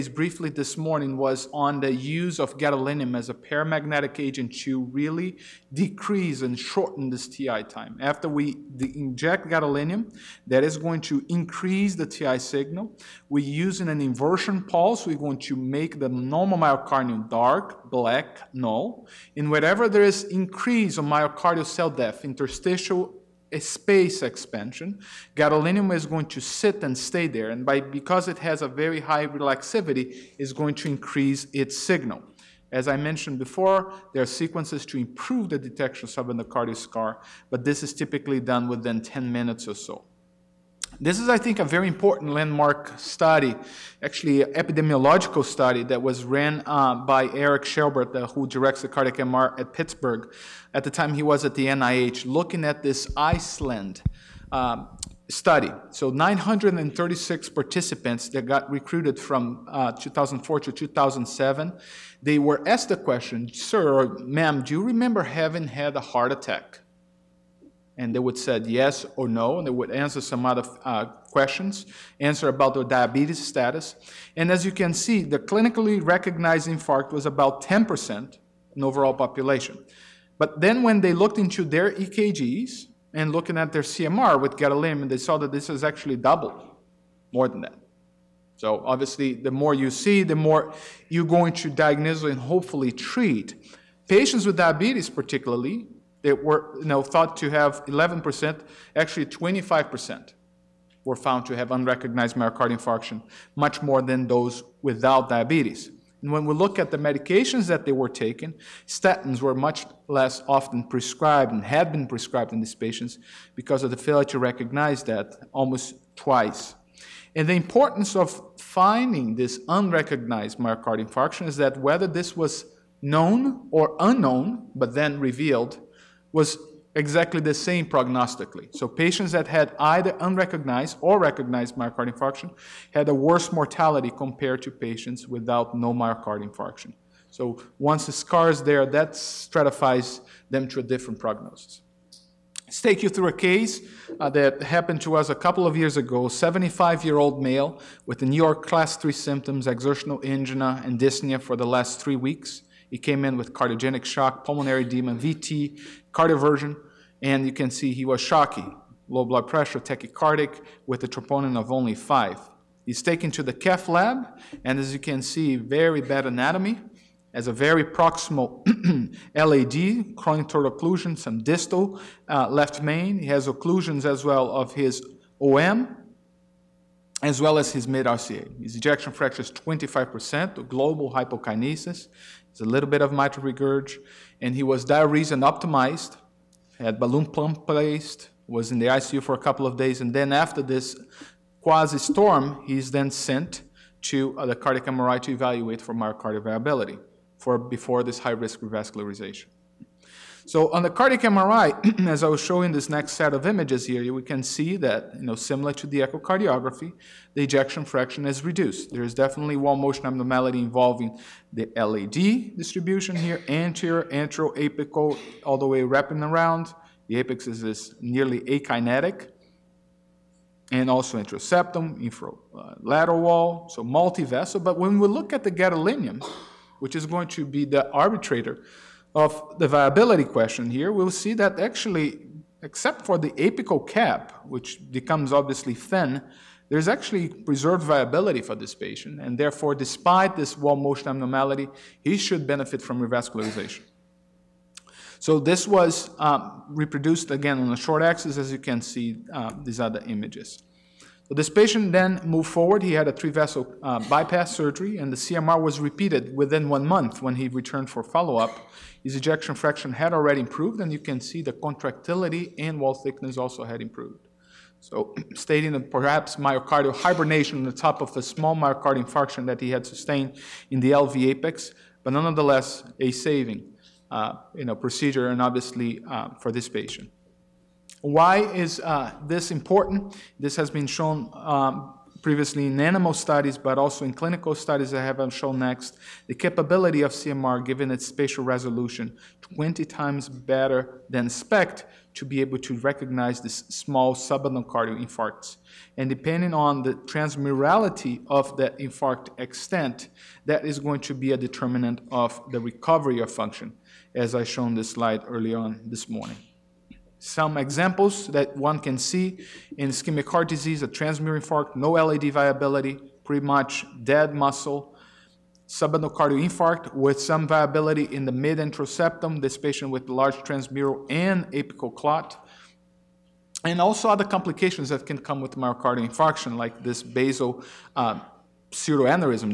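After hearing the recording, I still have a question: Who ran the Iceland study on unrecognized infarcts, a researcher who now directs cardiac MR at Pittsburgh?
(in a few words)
Eric Schelbert.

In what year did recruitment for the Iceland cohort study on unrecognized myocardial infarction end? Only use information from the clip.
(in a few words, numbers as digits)
2007.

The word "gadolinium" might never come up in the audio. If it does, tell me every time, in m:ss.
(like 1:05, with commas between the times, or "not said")
0:02, 0:09, 0:25, 1:24, 3:45.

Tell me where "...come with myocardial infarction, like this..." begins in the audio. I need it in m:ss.
5:25.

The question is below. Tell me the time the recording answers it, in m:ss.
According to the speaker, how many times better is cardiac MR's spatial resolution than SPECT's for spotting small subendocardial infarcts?
4:49.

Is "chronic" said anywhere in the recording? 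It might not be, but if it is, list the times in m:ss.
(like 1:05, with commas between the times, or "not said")
2:50.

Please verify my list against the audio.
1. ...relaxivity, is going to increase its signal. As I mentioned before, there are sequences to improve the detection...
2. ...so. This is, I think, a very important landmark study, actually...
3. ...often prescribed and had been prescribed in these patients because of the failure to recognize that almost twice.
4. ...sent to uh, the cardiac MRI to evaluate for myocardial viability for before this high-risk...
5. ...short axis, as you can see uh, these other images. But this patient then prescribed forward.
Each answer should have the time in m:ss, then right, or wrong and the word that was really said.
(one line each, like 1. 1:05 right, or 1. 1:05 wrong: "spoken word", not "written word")
1. 0:29 right
2. 0:39 right
3. 1:50 right
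4. 3:13 right
5. 4:07 wrong: "moved", not "prescribed".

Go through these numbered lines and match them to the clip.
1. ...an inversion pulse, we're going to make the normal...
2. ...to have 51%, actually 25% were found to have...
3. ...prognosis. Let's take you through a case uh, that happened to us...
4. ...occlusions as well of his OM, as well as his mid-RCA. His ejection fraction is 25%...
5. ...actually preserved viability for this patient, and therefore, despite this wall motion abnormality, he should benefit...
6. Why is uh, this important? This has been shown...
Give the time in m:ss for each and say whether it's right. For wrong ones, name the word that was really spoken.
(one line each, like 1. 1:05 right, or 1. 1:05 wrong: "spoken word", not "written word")
1. 0:13 right
2. 1:37 wrong: "11", not "51"
3. 2:21 right
4. 2:53 right
5. 3:56 right
6. 4:38 right.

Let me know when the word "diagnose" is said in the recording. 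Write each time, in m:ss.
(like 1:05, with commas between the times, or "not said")
1:31.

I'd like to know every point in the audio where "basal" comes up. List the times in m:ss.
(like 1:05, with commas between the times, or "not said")
5:27.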